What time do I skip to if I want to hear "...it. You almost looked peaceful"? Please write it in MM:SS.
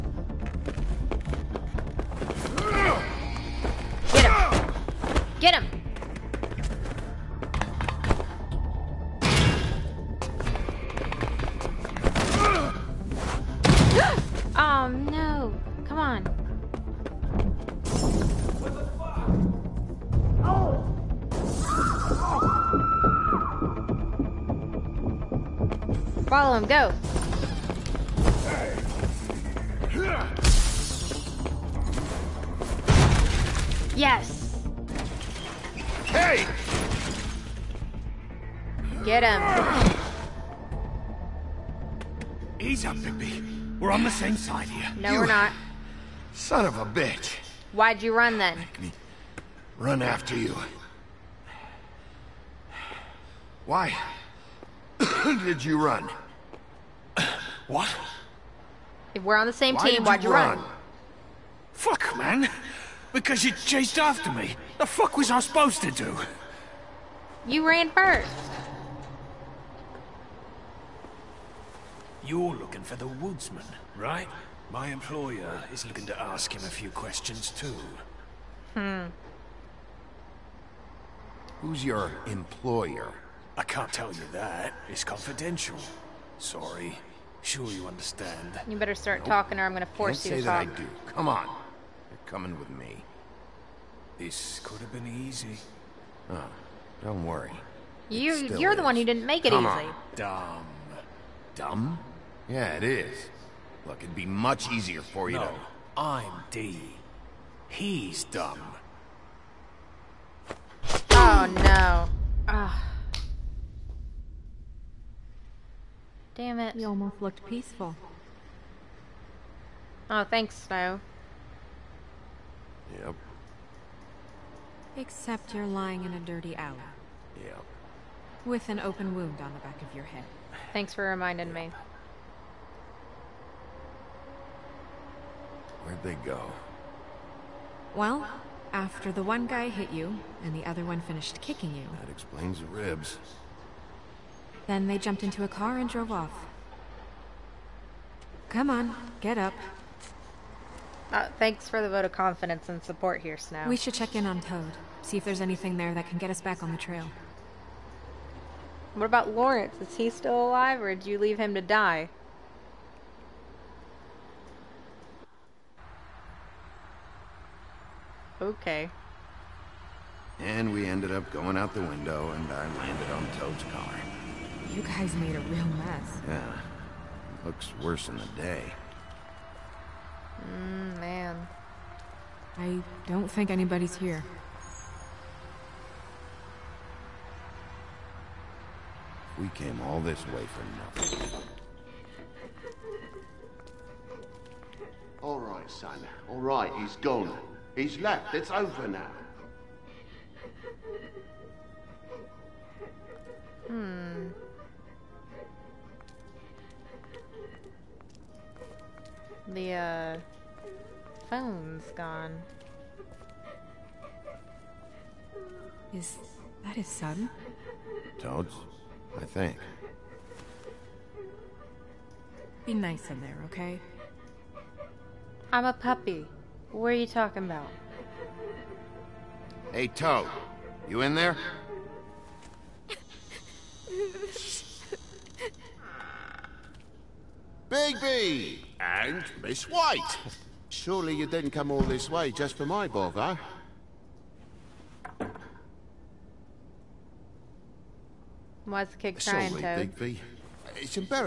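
01:56.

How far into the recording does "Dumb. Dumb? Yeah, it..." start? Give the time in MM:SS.
01:40.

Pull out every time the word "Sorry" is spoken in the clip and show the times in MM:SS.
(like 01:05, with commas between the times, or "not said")
01:26, 04:09.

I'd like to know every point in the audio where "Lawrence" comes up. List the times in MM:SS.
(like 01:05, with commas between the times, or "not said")
02:39.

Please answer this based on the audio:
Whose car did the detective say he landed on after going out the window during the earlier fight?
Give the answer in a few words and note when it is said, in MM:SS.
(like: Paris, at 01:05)
Toad's car, at 02:53.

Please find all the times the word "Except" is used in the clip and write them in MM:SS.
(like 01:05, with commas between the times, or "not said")
02:04.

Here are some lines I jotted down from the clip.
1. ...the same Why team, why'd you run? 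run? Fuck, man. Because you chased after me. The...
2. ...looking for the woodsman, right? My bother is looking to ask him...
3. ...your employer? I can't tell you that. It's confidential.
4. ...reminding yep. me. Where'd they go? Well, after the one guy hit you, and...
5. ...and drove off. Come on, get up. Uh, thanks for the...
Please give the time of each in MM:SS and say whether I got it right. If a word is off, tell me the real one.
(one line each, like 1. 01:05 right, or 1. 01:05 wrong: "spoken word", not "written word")
1. 00:59 right
2. 01:12 wrong: "employer", not "bother"
3. 01:21 right
4. 02:11 right
5. 02:25 right.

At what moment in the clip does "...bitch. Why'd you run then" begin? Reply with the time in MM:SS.
00:46.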